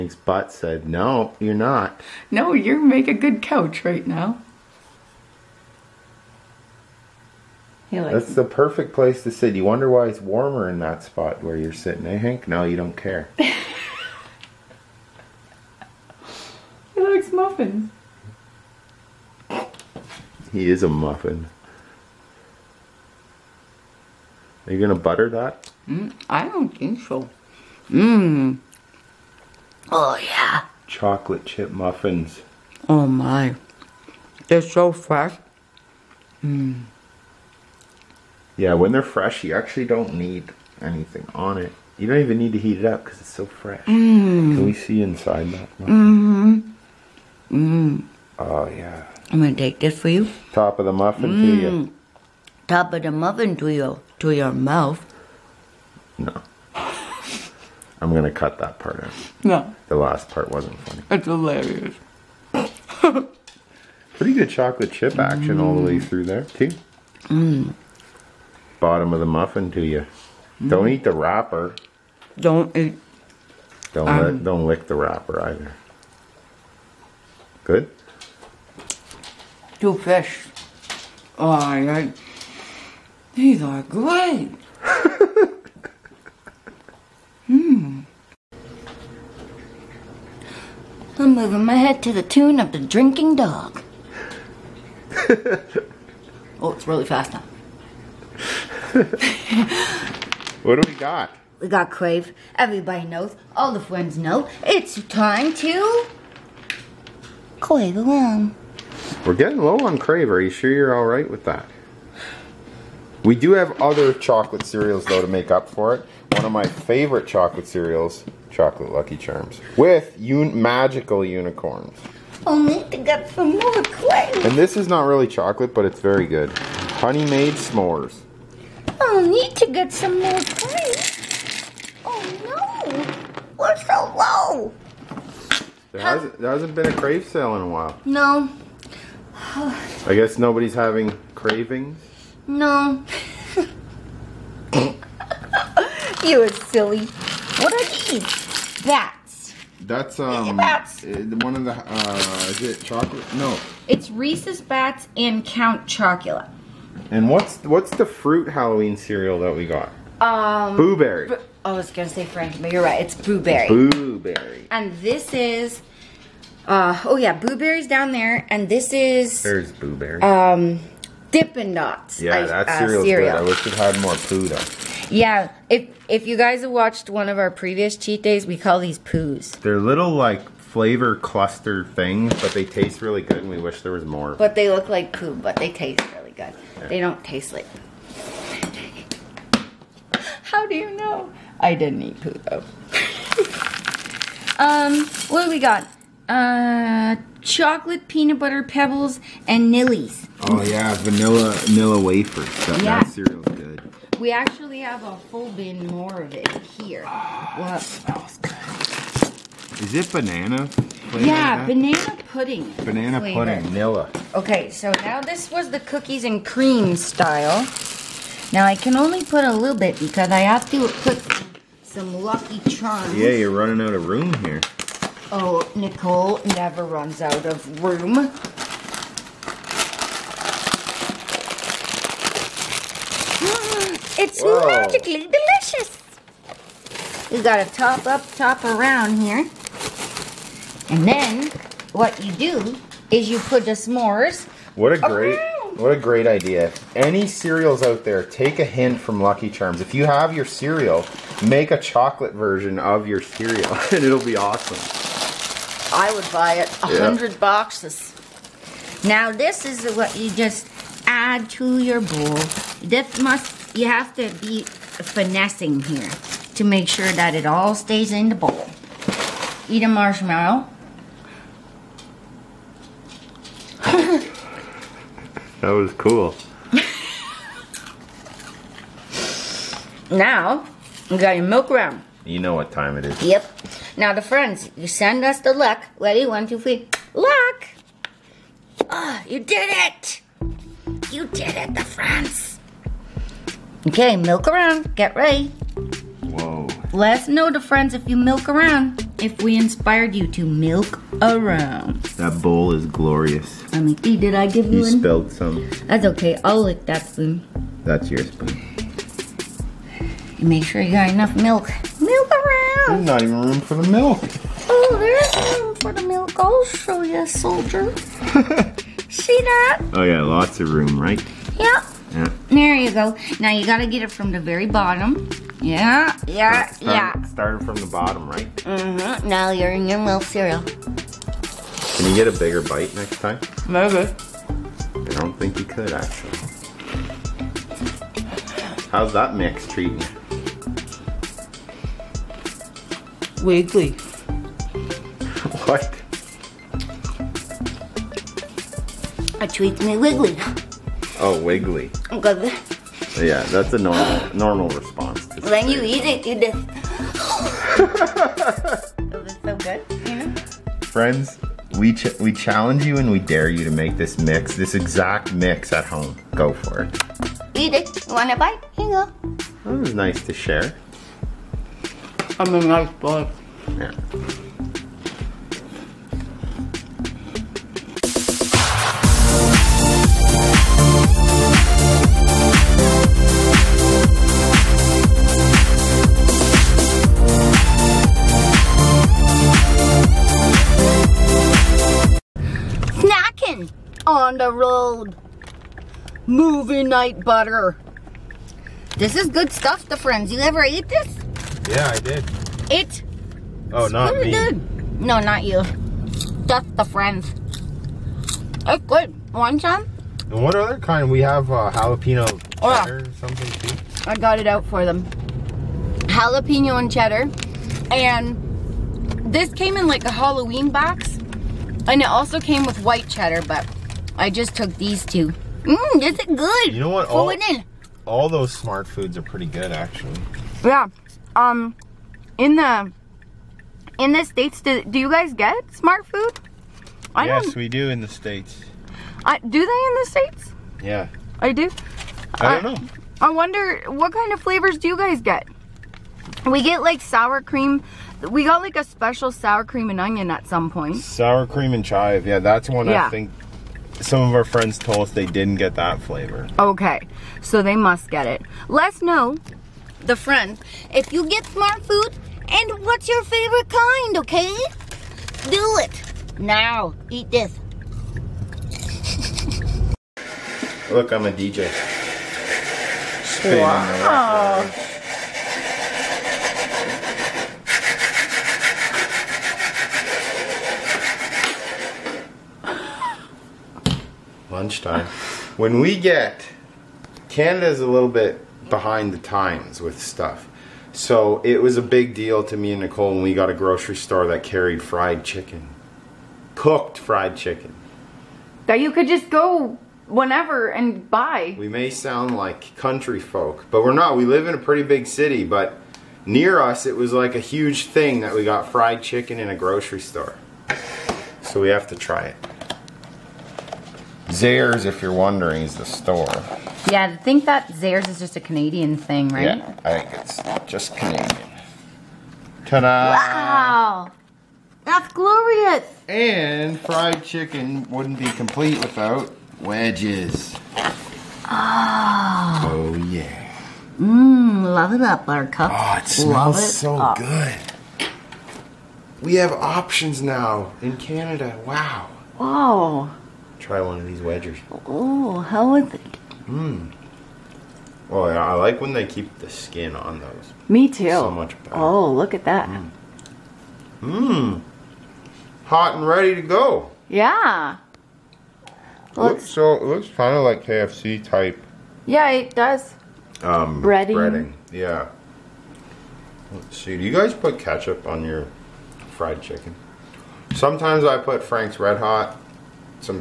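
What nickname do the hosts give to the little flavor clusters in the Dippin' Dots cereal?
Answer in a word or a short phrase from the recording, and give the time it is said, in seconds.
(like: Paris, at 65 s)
poos, at 178 s.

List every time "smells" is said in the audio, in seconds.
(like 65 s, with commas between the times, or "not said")
207 s, 536 s.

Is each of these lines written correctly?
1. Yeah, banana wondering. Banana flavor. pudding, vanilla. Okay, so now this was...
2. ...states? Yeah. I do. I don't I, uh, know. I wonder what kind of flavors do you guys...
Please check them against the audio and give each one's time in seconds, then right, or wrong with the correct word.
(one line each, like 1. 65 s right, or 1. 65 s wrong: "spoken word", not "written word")
1. 211 s wrong: "pudding", not "wondering"
2. 440 s right.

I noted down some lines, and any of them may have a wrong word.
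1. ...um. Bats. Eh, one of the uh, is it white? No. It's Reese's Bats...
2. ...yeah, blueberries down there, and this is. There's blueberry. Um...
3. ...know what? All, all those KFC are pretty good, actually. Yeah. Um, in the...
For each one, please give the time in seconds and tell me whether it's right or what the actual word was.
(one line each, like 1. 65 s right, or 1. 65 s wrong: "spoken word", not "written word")
1. 150 s wrong: "chocolate", not "white"
2. 167 s right
3. 426 s wrong: "Smartfoods", not "KFC".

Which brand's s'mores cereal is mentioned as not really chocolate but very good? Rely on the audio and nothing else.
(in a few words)
Honey Maid.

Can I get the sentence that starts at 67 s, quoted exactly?
Mm bottom of the muffin to you.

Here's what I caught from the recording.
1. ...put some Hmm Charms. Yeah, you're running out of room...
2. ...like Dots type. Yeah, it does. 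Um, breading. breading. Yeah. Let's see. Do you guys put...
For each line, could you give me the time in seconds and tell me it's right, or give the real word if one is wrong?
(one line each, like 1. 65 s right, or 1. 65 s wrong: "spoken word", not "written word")
1. 221 s wrong: "Lucky", not "Hmm"
2. 560 s wrong: "KFC", not "Dots".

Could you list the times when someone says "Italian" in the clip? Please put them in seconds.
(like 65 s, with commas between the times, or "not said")
not said.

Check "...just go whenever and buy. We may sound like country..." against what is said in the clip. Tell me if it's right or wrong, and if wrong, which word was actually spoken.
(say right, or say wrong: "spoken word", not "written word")
right.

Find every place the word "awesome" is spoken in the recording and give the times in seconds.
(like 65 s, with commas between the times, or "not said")
254 s.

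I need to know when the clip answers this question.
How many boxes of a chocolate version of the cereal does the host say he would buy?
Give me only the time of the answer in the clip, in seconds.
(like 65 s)
256 s.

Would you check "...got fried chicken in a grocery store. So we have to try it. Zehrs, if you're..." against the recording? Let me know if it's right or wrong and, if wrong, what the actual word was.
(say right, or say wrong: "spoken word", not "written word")
right.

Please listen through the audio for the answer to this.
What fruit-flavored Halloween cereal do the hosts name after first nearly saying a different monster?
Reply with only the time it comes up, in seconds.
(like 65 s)
160 s.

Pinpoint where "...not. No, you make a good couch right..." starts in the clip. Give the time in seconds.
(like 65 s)
1 s.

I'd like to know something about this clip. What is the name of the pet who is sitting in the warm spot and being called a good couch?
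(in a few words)
Hank.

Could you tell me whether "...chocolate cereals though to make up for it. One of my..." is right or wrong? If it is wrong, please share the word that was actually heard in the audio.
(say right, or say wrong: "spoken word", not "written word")
right.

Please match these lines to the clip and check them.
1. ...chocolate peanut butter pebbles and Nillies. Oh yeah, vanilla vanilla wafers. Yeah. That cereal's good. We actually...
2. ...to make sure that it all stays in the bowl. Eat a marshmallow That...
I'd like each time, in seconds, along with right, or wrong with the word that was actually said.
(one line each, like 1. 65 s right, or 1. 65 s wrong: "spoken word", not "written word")
1. 197 s right
2. 266 s right.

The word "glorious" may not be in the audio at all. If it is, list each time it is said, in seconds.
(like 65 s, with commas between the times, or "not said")
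302 s, 525 s.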